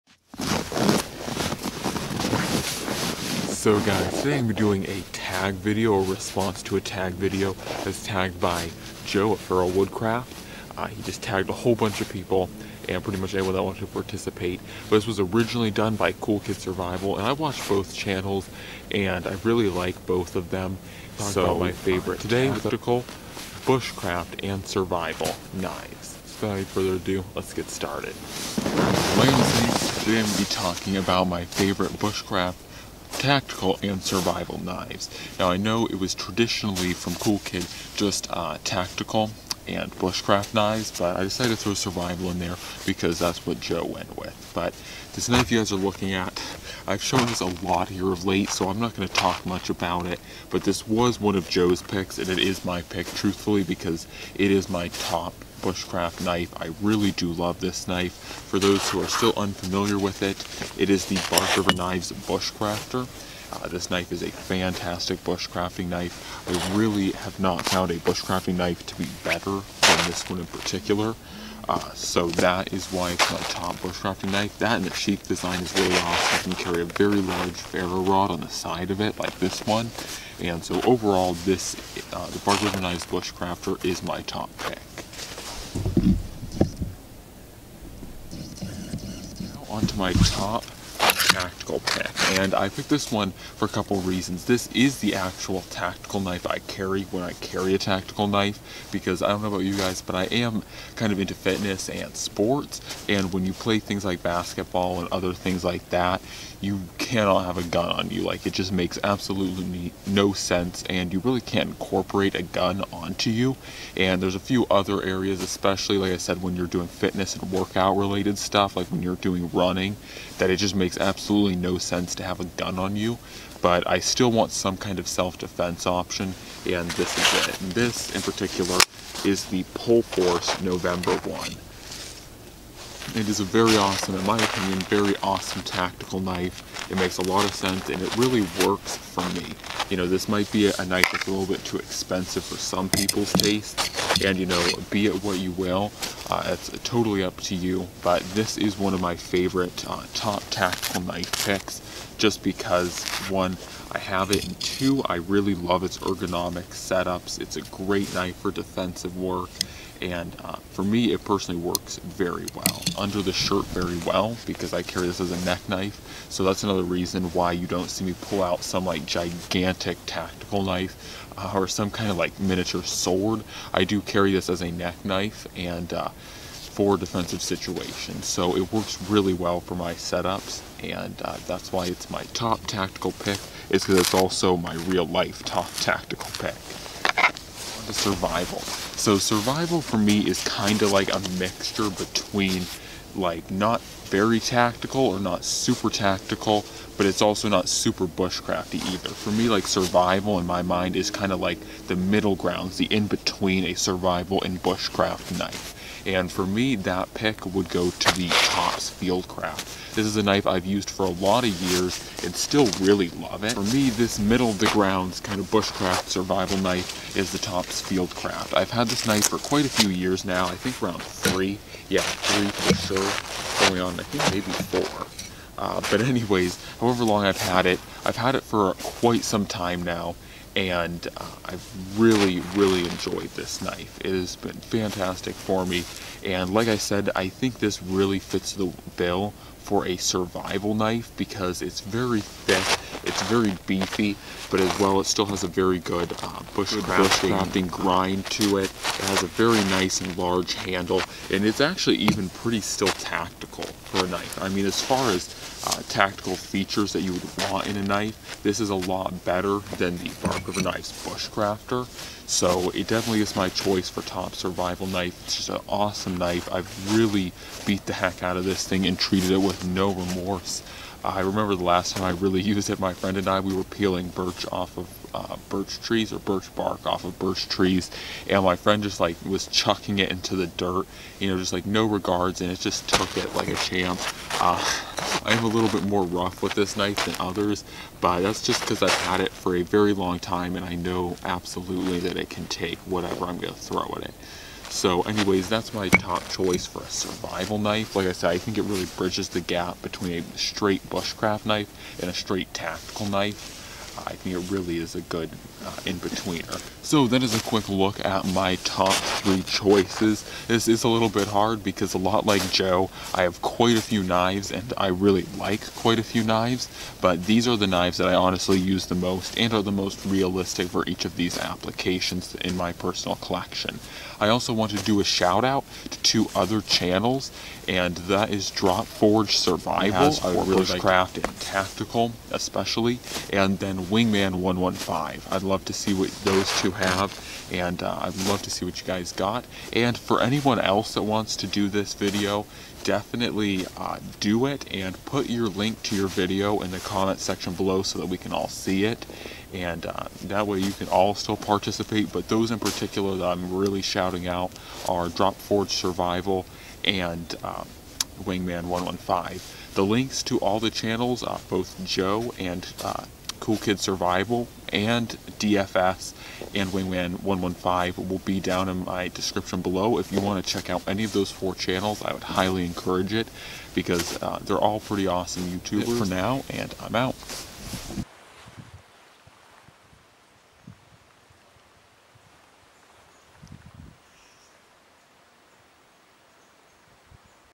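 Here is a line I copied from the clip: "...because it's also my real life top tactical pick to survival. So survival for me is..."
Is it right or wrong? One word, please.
right.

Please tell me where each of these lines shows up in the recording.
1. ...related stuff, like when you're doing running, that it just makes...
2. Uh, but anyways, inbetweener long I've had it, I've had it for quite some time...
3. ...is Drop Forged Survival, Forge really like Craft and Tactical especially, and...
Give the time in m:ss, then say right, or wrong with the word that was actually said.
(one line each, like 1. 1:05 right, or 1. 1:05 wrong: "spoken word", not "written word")
1. 1:57 right
2. 3:45 wrong: "however", not "inbetweener"
3. 5:28 right.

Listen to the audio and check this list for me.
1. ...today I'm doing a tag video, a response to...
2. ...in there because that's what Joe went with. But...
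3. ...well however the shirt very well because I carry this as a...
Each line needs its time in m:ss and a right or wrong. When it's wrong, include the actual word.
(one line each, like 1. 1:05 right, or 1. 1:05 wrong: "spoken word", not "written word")
1. 0:04 right
2. 0:42 right
3. 2:42 wrong: "under", not "however".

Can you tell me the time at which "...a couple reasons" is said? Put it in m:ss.
1:33.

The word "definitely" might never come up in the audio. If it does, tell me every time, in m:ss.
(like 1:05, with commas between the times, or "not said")
4:22, 5:42.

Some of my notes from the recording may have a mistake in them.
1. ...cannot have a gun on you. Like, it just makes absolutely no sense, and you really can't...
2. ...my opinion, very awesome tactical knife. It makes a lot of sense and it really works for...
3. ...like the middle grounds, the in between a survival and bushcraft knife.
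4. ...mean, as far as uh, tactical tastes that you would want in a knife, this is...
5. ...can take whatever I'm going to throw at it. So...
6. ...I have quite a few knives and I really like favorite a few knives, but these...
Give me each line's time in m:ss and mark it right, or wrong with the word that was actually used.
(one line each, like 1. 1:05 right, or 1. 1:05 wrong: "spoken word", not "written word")
1. 1:46 right
2. 2:14 right
3. 3:21 right
4. 4:14 wrong: "features", not "tastes"
5. 4:52 right
6. 5:13 wrong: "quite", not "favorite".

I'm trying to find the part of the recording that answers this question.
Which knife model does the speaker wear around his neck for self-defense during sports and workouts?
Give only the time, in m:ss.
2:09.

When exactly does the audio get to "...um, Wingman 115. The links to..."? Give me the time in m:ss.
5:57.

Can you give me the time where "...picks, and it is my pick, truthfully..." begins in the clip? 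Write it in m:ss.
0:51.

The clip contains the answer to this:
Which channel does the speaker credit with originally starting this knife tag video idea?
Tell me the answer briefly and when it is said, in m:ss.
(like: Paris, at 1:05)
Cool Kid Survival, at 0:16.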